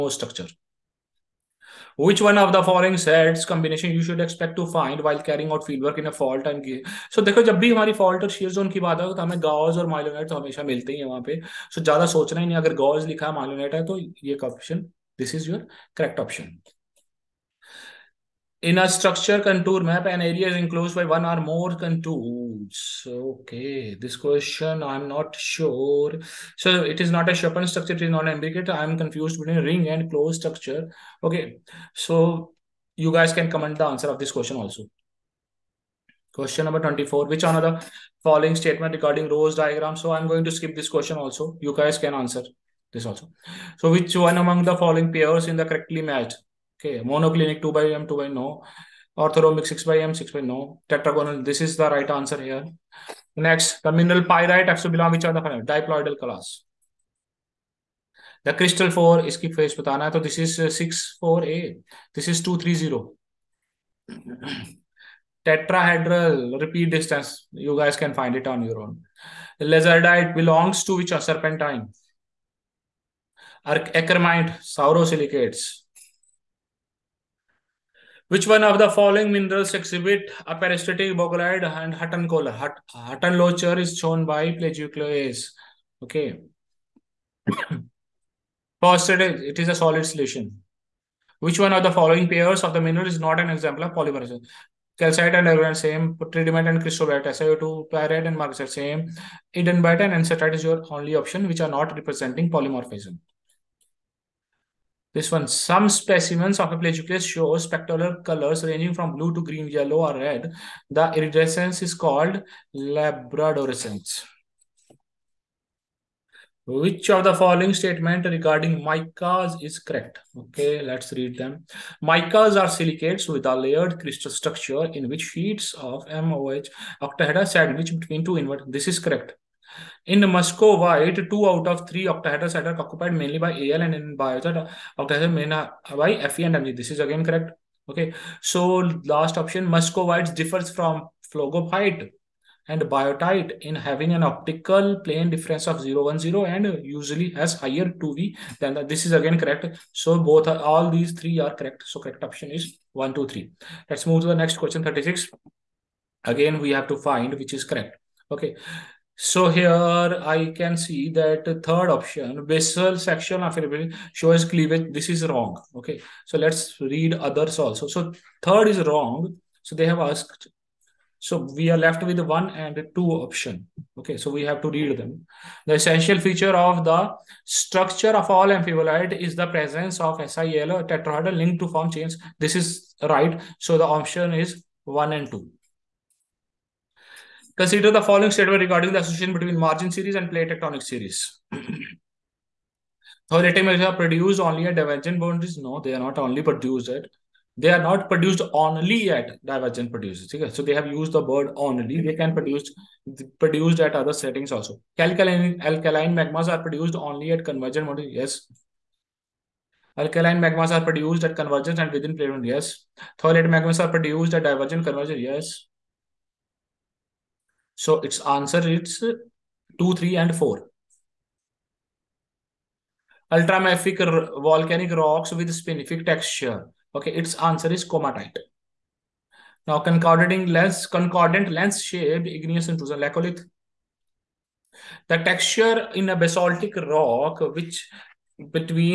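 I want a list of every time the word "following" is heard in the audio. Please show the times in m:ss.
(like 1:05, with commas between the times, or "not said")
0:02, 0:38, 0:44, 1:18, 1:31, 1:57, 3:08.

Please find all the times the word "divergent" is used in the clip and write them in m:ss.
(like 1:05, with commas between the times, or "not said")
3:14, 3:19, 3:34.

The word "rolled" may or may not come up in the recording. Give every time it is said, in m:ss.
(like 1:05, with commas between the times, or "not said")
not said.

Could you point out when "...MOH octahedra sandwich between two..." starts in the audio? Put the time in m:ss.
2:06.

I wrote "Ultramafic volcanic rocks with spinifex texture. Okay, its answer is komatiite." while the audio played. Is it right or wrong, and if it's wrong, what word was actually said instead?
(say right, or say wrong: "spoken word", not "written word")
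right.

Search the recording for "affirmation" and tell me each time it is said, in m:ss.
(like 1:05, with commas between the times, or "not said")
2:43.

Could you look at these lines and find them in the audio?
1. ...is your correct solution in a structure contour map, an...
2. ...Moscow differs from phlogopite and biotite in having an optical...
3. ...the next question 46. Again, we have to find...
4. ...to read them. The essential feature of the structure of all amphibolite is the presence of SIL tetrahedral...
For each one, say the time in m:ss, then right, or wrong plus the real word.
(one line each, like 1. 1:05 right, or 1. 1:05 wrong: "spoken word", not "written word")
1. 0:15 wrong: "option", not "solution"
2. 2:19 right
3. 2:34 wrong: "36", not "46"
4. 2:54 right.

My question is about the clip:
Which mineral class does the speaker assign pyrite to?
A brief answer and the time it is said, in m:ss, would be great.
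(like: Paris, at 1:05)
diploidal, at 0:55.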